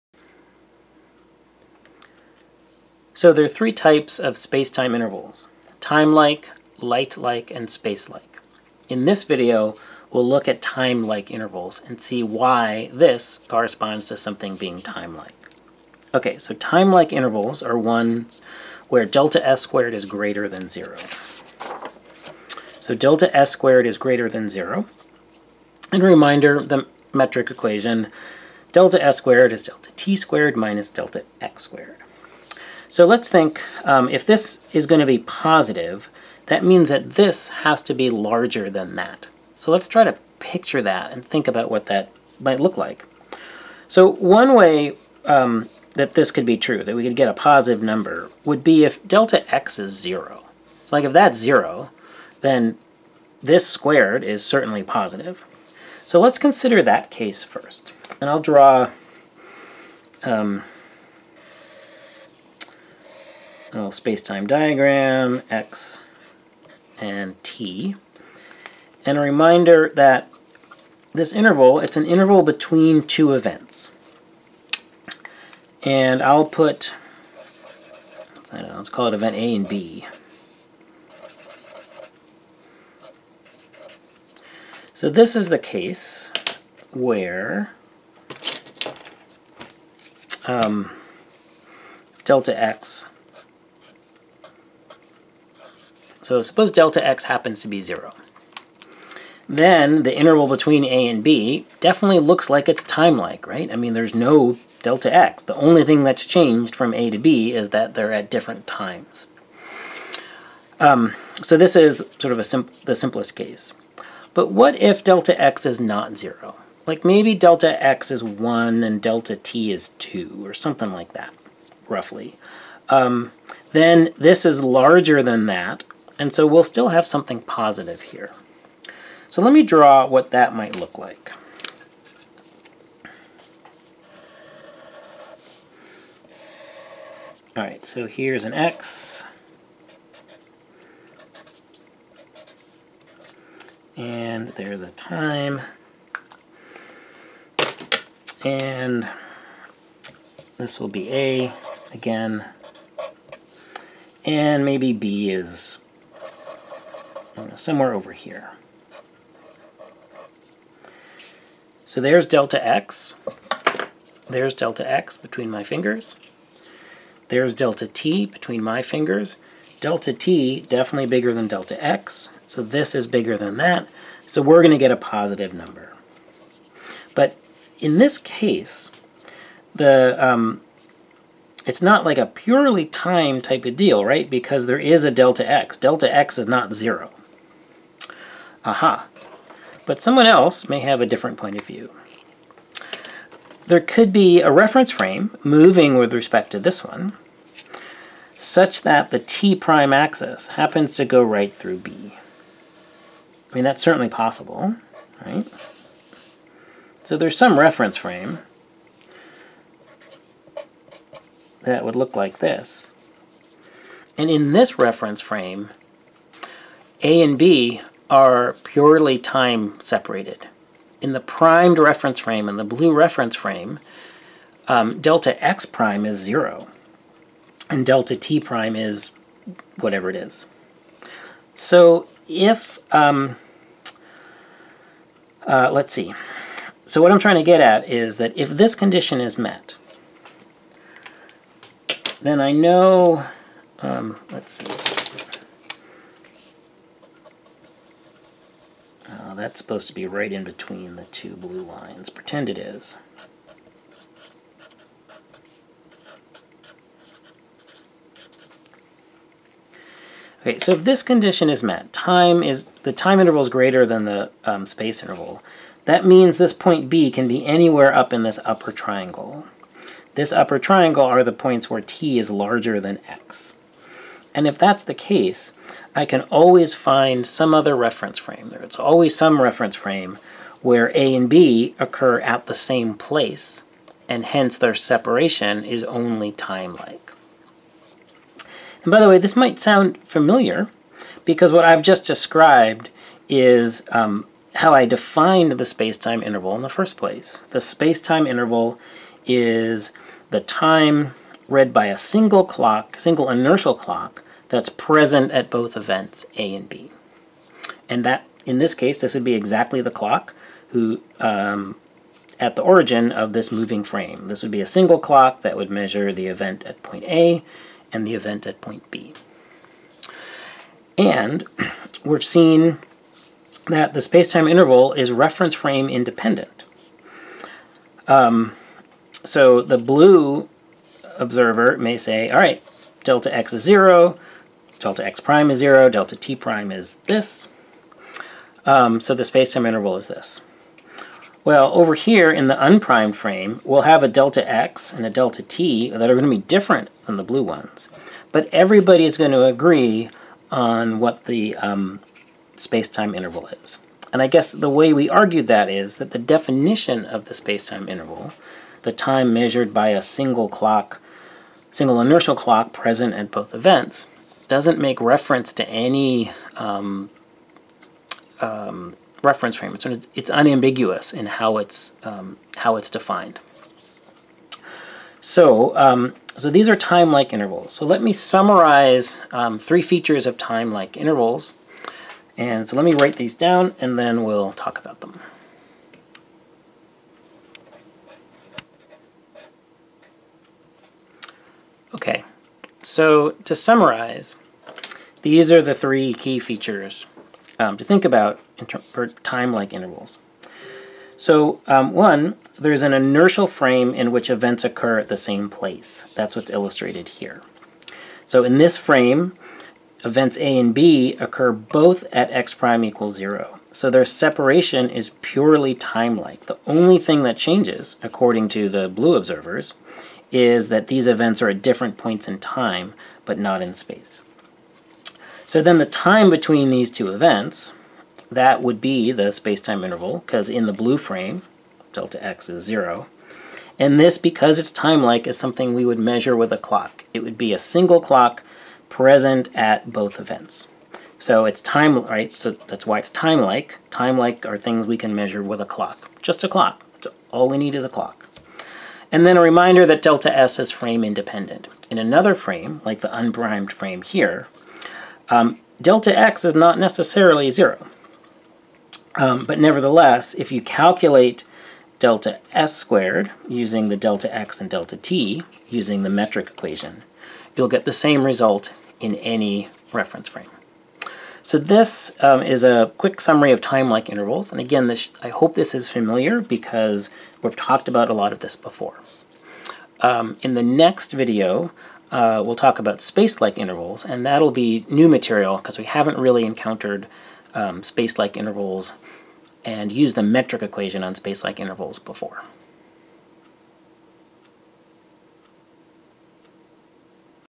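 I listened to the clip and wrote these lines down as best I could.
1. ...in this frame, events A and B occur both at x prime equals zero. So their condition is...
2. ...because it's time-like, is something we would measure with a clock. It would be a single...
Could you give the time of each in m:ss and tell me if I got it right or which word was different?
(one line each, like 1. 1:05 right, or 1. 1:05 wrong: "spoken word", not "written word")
1. 6:48 wrong: "separation", not "condition"
2. 7:14 right.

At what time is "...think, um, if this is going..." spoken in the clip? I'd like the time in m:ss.
0:33.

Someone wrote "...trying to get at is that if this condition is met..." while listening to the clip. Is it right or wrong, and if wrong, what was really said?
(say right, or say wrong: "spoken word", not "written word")
right.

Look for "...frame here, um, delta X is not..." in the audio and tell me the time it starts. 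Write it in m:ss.
7:33.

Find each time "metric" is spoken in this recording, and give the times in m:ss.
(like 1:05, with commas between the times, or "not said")
0:27, 7:46, 8:10.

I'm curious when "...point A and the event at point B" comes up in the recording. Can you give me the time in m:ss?
5:16.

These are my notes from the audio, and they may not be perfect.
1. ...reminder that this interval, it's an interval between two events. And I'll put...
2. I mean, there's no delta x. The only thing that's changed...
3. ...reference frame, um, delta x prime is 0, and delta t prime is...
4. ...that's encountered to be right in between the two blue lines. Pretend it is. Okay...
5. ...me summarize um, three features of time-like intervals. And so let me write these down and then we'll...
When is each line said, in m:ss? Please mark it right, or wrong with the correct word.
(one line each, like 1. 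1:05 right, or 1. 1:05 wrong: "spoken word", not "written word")
1. 1:09 right
2. 1:43 right
3. 3:42 right
4. 4:09 wrong: "supposed", not "encountered"
5. 6:18 right.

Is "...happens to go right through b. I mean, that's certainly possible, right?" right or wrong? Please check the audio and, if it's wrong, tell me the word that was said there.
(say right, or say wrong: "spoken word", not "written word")
right.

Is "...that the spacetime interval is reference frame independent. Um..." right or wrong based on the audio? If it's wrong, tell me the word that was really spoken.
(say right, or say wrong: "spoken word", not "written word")
right.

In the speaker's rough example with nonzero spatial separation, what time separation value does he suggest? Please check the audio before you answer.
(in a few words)
2.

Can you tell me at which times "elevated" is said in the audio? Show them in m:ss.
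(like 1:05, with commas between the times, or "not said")
not said.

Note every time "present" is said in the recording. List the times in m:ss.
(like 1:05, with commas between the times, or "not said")
5:04, 6:02, 7:18.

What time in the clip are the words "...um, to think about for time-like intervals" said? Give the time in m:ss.
6:37.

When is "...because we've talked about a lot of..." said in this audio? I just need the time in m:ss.
7:56.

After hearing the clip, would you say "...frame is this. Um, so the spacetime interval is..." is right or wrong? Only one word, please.
wrong.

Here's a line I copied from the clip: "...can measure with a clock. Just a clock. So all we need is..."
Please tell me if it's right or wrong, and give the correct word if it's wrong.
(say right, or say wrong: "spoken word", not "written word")
right.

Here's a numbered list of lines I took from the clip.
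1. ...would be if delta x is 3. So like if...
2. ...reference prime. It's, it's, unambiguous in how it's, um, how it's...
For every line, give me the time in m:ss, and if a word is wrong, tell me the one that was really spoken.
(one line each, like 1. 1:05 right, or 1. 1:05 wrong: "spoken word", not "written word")
1. 0:48 wrong: "0", not "3"
2. 6:09 wrong: "frame", not "prime".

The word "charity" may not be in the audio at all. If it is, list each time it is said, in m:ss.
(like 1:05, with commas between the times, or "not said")
not said.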